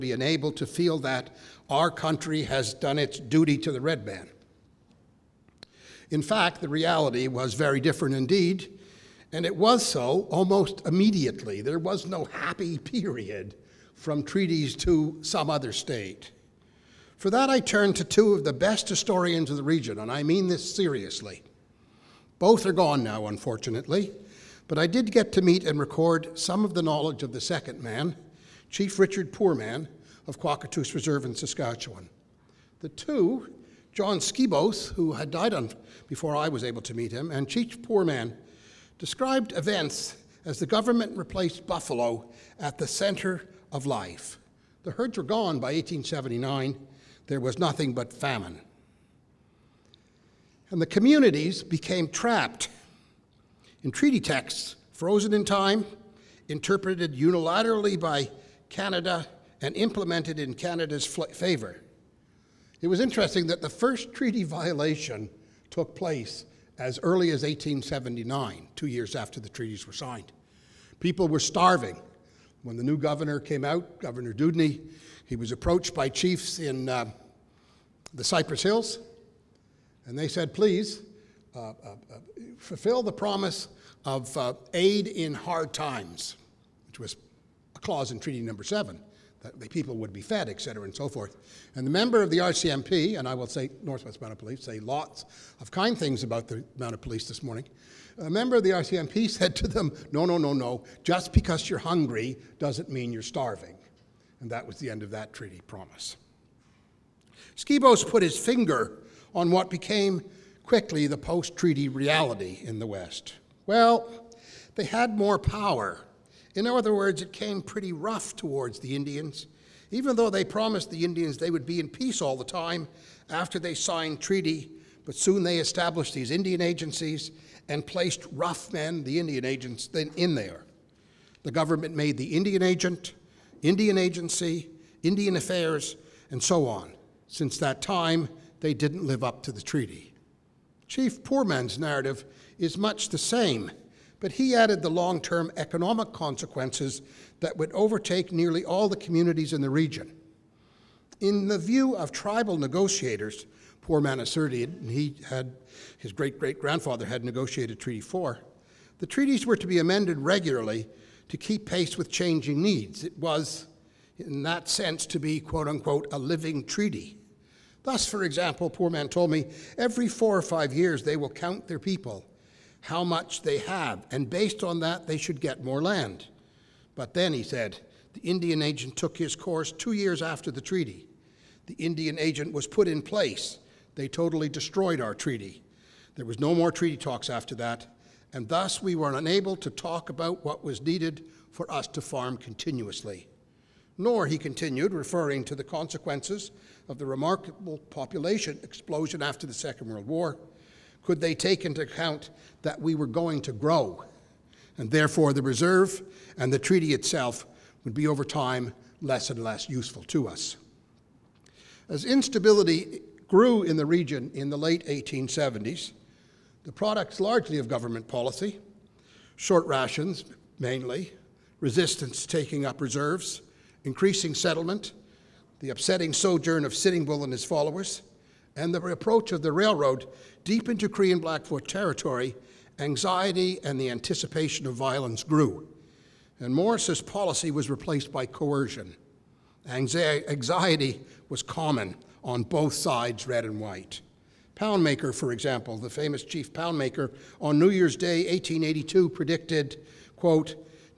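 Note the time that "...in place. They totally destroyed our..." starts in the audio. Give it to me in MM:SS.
03:02.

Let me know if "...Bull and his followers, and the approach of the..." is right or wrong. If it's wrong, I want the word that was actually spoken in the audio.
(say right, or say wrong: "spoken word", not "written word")
right.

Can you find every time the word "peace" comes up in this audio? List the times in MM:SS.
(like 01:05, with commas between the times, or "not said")
02:01.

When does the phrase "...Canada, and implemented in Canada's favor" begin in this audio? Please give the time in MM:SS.
00:58.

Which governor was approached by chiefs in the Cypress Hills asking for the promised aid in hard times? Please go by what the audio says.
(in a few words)
Governor Dewdney.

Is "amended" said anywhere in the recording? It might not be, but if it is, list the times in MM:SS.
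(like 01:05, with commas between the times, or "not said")
02:39.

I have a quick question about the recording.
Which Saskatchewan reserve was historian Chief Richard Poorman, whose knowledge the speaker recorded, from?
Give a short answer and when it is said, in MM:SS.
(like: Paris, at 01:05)
Kawacatoose Reserve, at 00:30.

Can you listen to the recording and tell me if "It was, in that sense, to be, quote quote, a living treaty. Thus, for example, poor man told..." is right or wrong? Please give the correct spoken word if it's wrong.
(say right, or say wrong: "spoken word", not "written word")
wrong: "unquote", not "quote".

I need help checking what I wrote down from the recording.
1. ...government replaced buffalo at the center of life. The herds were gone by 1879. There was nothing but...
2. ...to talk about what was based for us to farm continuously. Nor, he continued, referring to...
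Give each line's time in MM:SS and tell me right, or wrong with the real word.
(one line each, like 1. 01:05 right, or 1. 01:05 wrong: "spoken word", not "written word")
1. 00:40 right
2. 03:09 wrong: "needed", not "based".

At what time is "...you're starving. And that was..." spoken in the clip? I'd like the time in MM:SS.
01:43.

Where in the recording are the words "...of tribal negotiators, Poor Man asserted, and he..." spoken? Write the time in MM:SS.
02:31.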